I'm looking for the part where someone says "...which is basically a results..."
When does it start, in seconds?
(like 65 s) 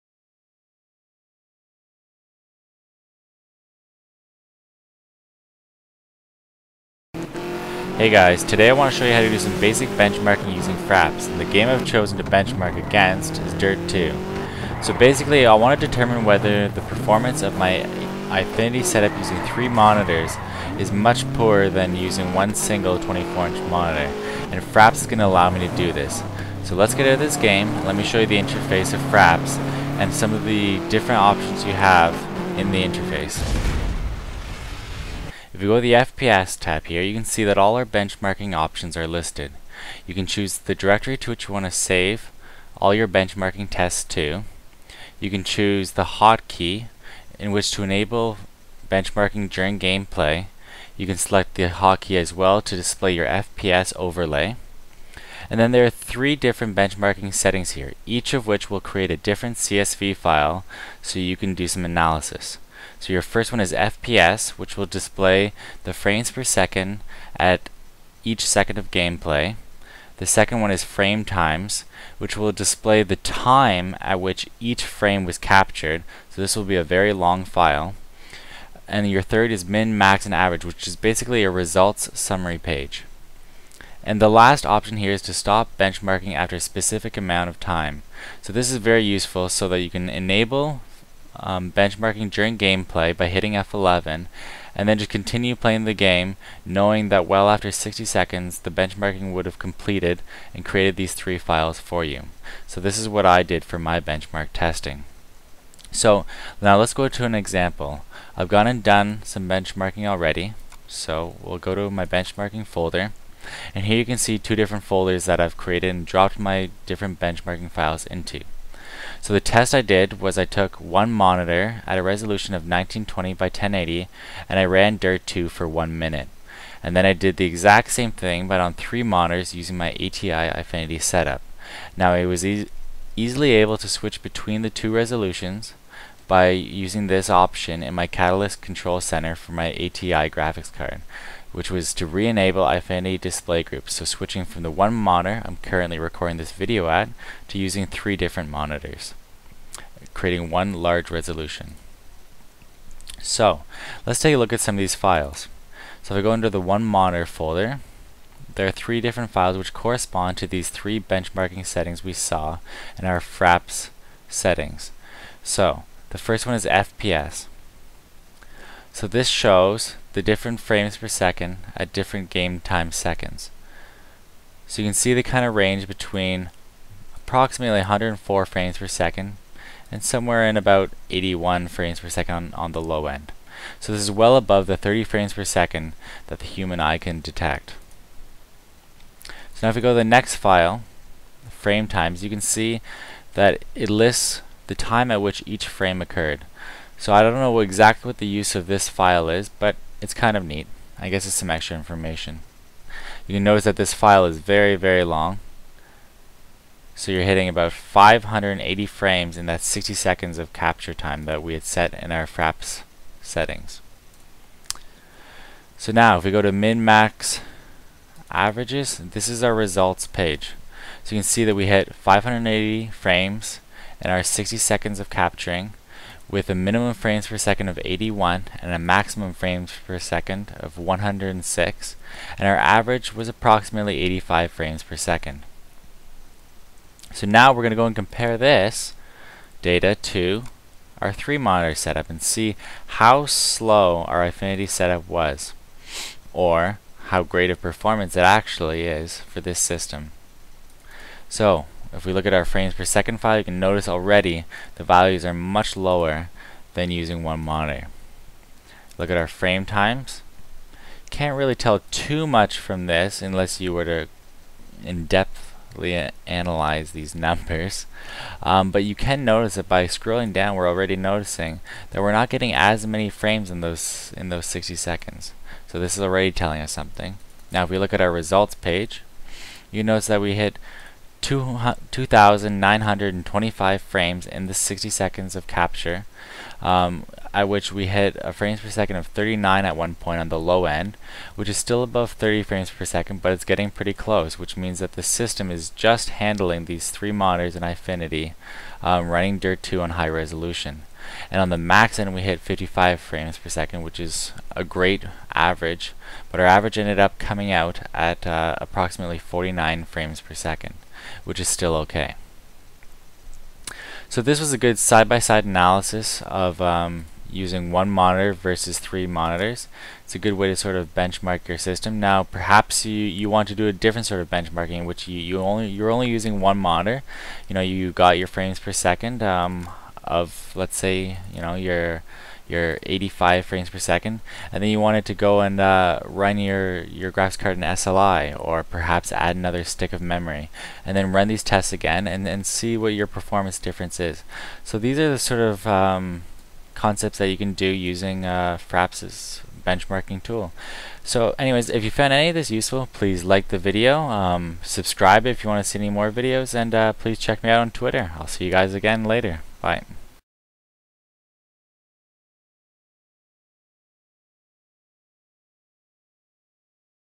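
80 s.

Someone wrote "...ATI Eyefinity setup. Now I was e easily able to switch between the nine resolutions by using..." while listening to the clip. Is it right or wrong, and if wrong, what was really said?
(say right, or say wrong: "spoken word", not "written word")
wrong: "two", not "nine".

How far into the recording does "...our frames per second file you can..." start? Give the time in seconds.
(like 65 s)
252 s.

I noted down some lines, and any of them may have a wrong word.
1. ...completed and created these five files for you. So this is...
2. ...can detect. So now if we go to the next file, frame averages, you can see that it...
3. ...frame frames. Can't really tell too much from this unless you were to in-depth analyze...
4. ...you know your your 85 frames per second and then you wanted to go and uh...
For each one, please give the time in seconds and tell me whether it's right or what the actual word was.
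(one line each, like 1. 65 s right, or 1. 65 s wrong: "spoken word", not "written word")
1. 99 s wrong: "three", not "five"
2. 186 s wrong: "times", not "averages"
3. 259 s wrong: "times", not "frames"
4. 331 s right.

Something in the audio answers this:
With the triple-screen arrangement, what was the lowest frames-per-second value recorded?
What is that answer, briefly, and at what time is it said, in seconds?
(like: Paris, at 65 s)
39, at 289 s.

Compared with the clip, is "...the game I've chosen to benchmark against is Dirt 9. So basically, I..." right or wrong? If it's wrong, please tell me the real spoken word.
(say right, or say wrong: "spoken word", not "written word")
wrong: "2", not "9".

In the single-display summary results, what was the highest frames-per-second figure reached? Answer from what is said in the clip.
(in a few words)
106.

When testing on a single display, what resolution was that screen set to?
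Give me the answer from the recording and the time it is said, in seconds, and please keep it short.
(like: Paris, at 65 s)
1920 by 1080, at 122 s.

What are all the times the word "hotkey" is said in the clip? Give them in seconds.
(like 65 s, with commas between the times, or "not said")
46 s, 51 s.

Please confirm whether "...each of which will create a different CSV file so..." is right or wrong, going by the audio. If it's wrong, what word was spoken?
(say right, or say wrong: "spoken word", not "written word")
right.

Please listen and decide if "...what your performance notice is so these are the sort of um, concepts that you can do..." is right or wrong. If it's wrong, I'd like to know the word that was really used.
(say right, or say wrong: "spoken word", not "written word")
wrong: "difference", not "notice".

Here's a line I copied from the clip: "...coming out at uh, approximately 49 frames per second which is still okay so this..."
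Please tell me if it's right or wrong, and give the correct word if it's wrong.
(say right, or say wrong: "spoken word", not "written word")
right.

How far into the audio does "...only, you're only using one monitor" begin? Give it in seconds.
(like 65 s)
325 s.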